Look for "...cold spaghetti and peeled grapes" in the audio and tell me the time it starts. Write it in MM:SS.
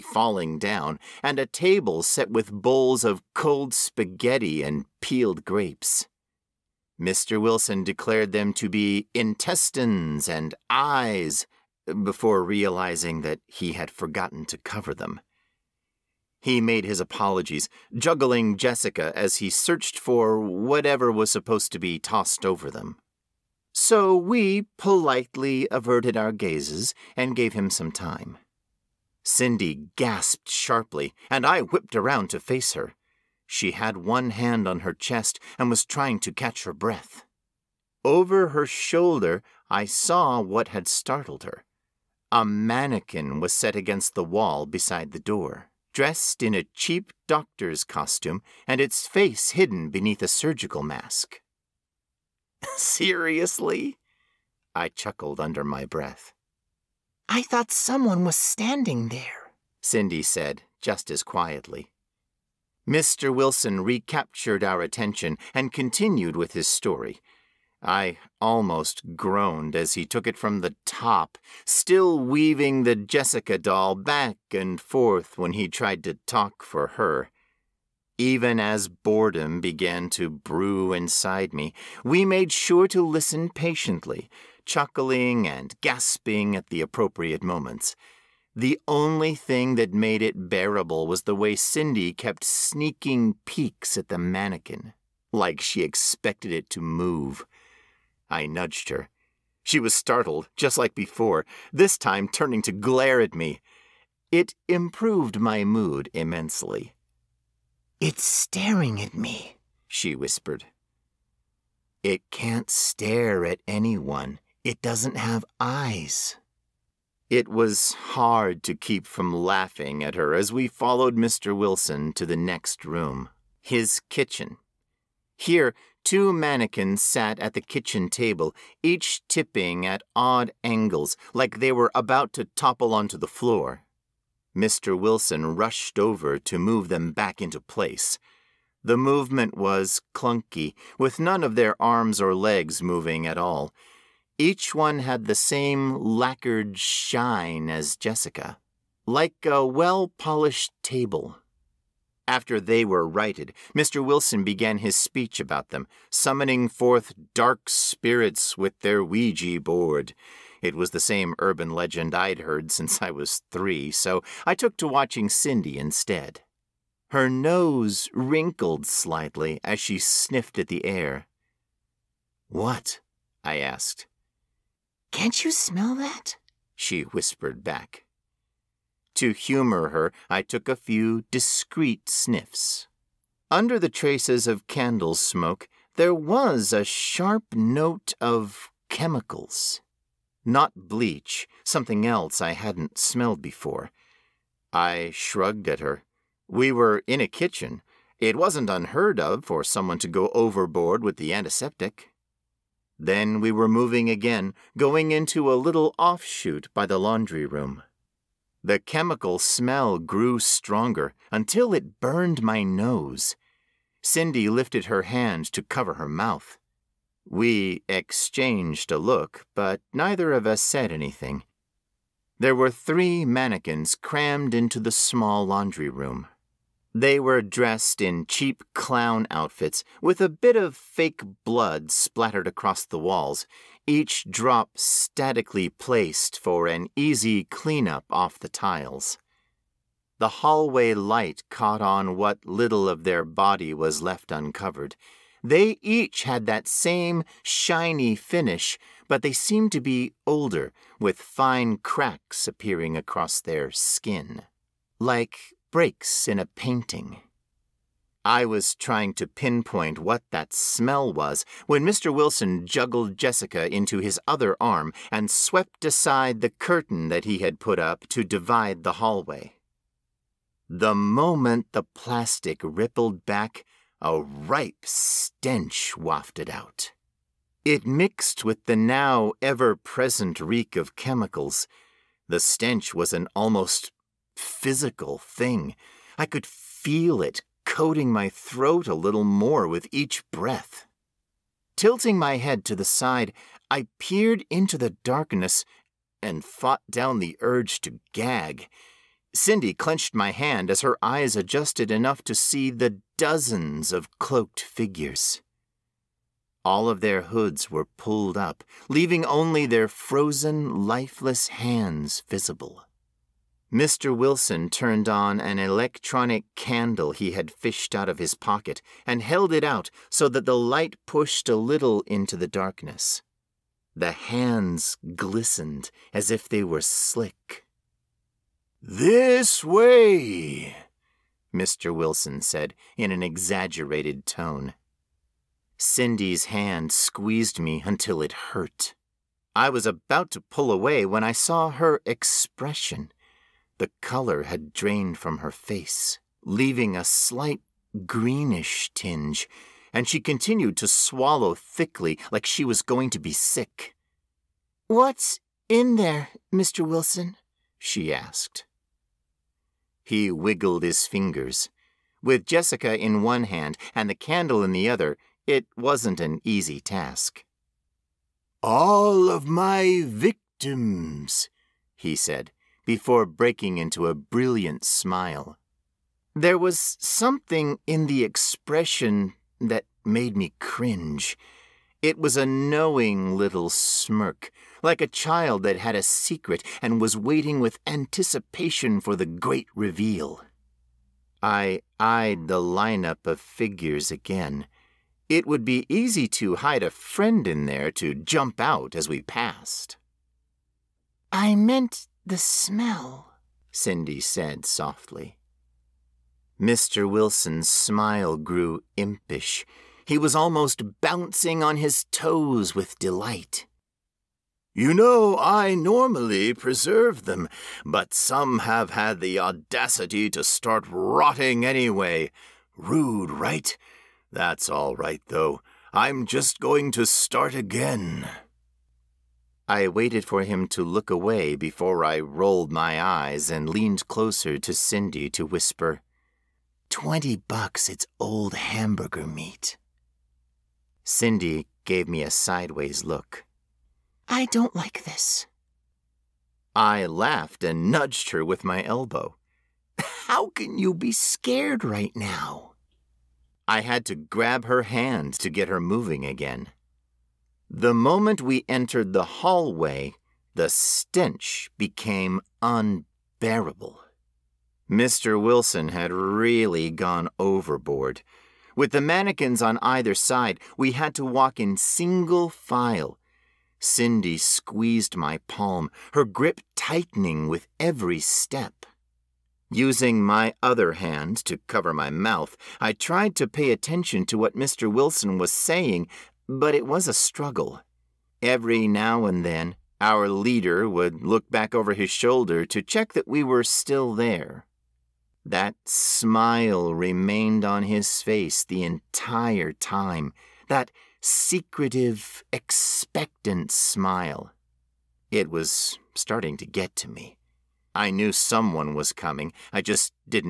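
00:03.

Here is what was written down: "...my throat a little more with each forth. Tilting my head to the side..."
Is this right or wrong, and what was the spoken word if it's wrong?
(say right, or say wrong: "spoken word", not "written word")
wrong: "breath", not "forth".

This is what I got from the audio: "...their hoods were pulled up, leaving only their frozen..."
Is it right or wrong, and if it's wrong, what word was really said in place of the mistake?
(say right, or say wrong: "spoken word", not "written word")
right.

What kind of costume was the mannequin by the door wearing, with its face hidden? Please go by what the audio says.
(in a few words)
doctor's costume.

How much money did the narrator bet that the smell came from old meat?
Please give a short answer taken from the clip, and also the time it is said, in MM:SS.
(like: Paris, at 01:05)
$20, at 07:16.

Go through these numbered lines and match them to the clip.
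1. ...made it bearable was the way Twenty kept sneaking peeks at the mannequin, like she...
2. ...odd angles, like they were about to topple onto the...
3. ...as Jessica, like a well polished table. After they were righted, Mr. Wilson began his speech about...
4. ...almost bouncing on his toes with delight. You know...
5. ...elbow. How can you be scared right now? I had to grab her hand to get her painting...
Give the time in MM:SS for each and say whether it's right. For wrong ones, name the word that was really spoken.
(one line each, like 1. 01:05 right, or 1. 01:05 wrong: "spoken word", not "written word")
1. 01:29 wrong: "Cindy", not "Twenty"
2. 02:10 right
3. 02:27 right
4. 06:50 right
5. 07:28 wrong: "moving", not "painting".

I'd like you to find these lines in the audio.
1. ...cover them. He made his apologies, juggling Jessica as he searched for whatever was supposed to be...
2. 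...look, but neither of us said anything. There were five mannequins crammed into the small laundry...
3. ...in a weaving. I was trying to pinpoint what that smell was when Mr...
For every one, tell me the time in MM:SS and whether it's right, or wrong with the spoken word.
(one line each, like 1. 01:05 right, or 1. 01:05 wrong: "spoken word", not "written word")
1. 00:14 right
2. 03:38 wrong: "three", not "five"
3. 04:16 wrong: "painting", not "weaving".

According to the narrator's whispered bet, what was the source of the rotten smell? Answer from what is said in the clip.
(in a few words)
old hamburger meat.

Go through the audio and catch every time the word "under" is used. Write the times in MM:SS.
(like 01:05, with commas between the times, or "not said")
00:55, 03:03.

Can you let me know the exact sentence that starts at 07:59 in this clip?
Using my other hand to cover my mouth, I tried to pay attention to what Mr.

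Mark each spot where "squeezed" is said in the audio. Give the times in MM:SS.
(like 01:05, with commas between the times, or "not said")
05:36, 07:54.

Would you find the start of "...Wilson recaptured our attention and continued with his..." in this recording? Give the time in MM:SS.
01:03.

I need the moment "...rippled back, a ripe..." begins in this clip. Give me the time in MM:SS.
04:32.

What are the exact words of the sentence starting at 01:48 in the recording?
It's staring at me, she whispered.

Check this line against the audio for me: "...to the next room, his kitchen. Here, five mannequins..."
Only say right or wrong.
wrong.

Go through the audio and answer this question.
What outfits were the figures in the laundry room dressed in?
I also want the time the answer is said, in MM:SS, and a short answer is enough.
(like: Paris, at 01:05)
clown outfits, at 03:48.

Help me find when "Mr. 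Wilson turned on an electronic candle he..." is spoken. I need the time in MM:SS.
05:13.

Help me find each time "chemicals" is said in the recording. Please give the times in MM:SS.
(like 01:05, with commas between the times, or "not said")
03:08, 03:28, 04:40.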